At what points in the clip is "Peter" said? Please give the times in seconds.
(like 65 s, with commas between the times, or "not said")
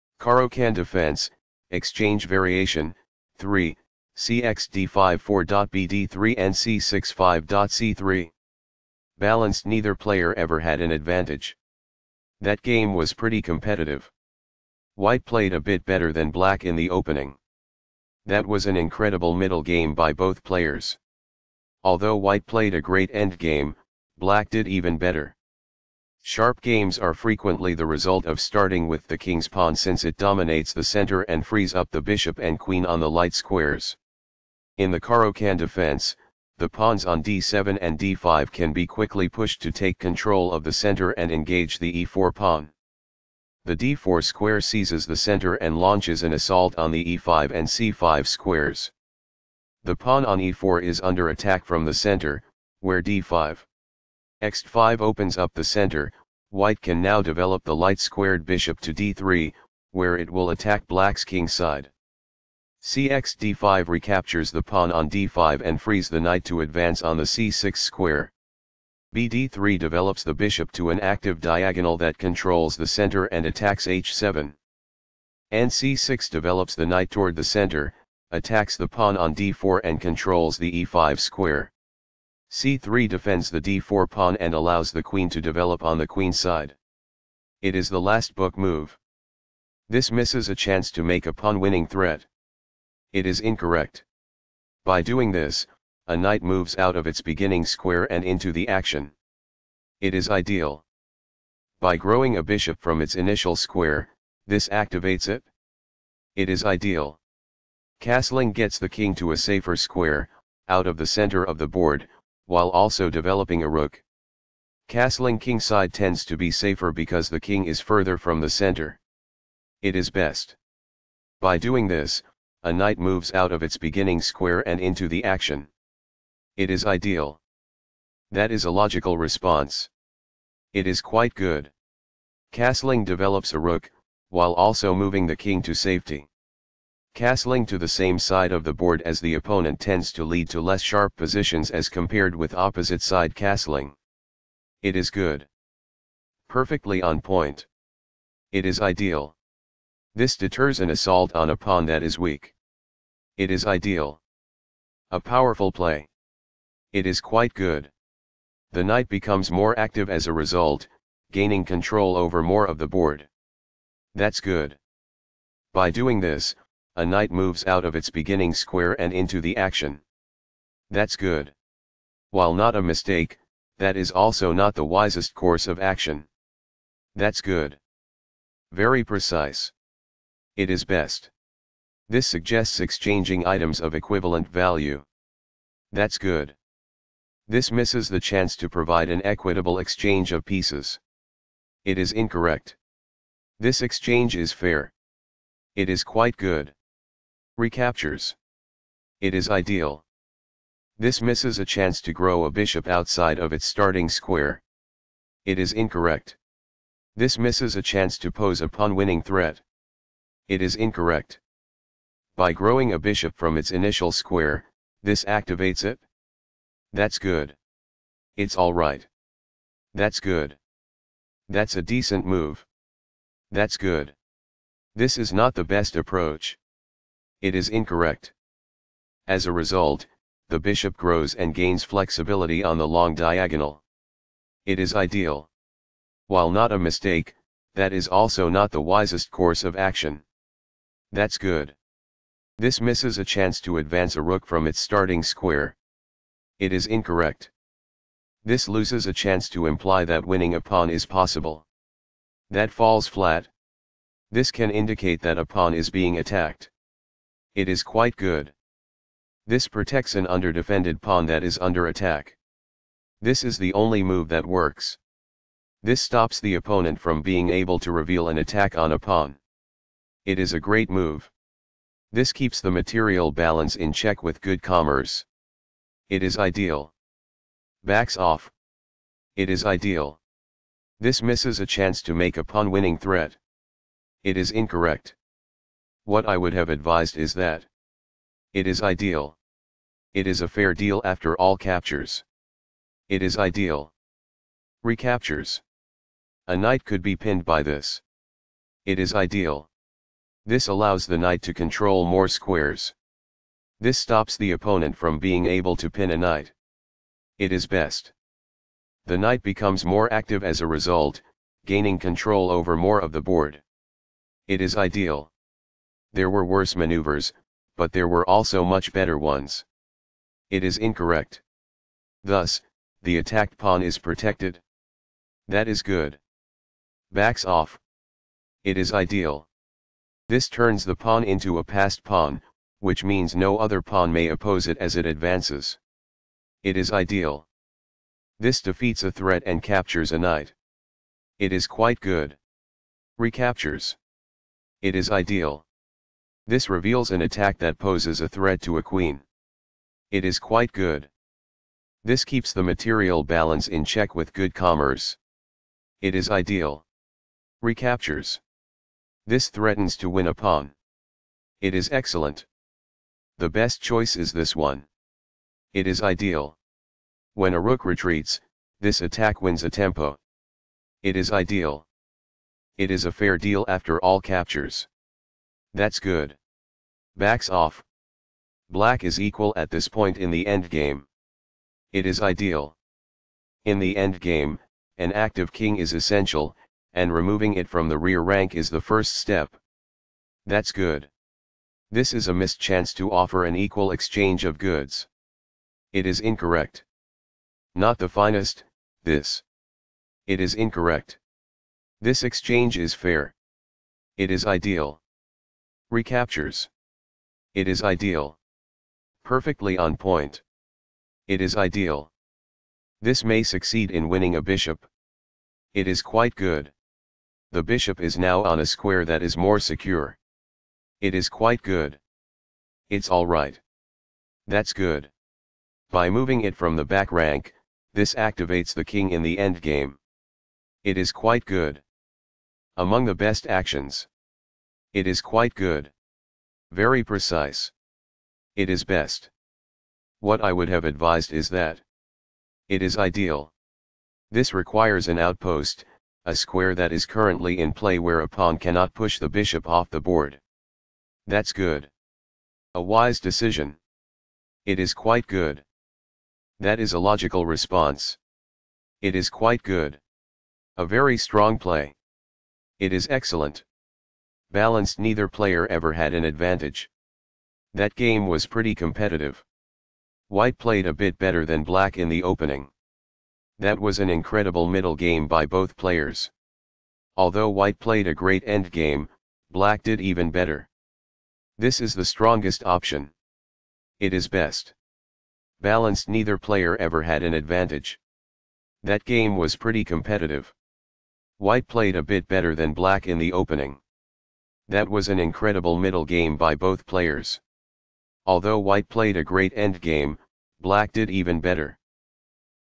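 not said.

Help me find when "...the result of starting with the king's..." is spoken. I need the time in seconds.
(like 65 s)
27 s.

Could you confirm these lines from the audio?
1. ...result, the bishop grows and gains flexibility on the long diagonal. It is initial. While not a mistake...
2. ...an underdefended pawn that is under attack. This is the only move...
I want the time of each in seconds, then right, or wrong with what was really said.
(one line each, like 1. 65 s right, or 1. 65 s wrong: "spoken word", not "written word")
1. 229 s wrong: "ideal", not "initial"
2. 260 s right.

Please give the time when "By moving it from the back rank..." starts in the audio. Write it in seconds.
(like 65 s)
425 s.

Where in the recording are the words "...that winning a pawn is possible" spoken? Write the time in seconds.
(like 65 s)
250 s.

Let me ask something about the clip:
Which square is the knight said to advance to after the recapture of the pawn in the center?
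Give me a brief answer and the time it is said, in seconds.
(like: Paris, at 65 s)
c6, at 66 s.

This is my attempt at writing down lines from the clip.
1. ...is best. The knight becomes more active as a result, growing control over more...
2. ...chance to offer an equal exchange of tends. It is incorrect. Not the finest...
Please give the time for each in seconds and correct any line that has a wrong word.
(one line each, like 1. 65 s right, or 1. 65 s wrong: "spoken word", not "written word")
1. 307 s wrong: "gaining", not "growing"
2. 392 s wrong: "goods", not "tends".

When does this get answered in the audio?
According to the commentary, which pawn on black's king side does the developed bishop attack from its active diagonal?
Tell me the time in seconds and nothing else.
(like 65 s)
73 s.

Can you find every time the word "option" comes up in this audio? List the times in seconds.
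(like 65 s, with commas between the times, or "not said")
482 s.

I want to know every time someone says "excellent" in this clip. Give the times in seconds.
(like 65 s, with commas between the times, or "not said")
361 s, 463 s.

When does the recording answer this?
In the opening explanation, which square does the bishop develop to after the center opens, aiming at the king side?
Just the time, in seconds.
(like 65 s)
57 s.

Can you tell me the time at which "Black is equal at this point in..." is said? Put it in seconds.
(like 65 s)
378 s.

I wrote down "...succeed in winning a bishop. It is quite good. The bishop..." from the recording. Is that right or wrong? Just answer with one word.
right.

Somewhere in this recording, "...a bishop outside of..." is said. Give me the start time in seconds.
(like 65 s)
202 s.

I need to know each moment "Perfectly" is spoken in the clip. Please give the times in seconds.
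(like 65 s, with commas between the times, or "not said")
146 s, 409 s.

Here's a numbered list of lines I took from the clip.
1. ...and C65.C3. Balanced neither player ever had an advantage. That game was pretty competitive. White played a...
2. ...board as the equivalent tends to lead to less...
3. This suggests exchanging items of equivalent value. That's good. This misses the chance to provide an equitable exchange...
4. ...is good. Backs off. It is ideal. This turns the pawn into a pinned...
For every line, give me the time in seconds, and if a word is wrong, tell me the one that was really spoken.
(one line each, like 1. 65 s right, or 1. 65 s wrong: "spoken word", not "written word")
1. 6 s right
2. 138 s wrong: "opponent", not "equivalent"
3. 182 s right
4. 325 s wrong: "passed", not "pinned".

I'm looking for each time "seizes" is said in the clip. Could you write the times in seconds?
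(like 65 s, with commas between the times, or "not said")
44 s.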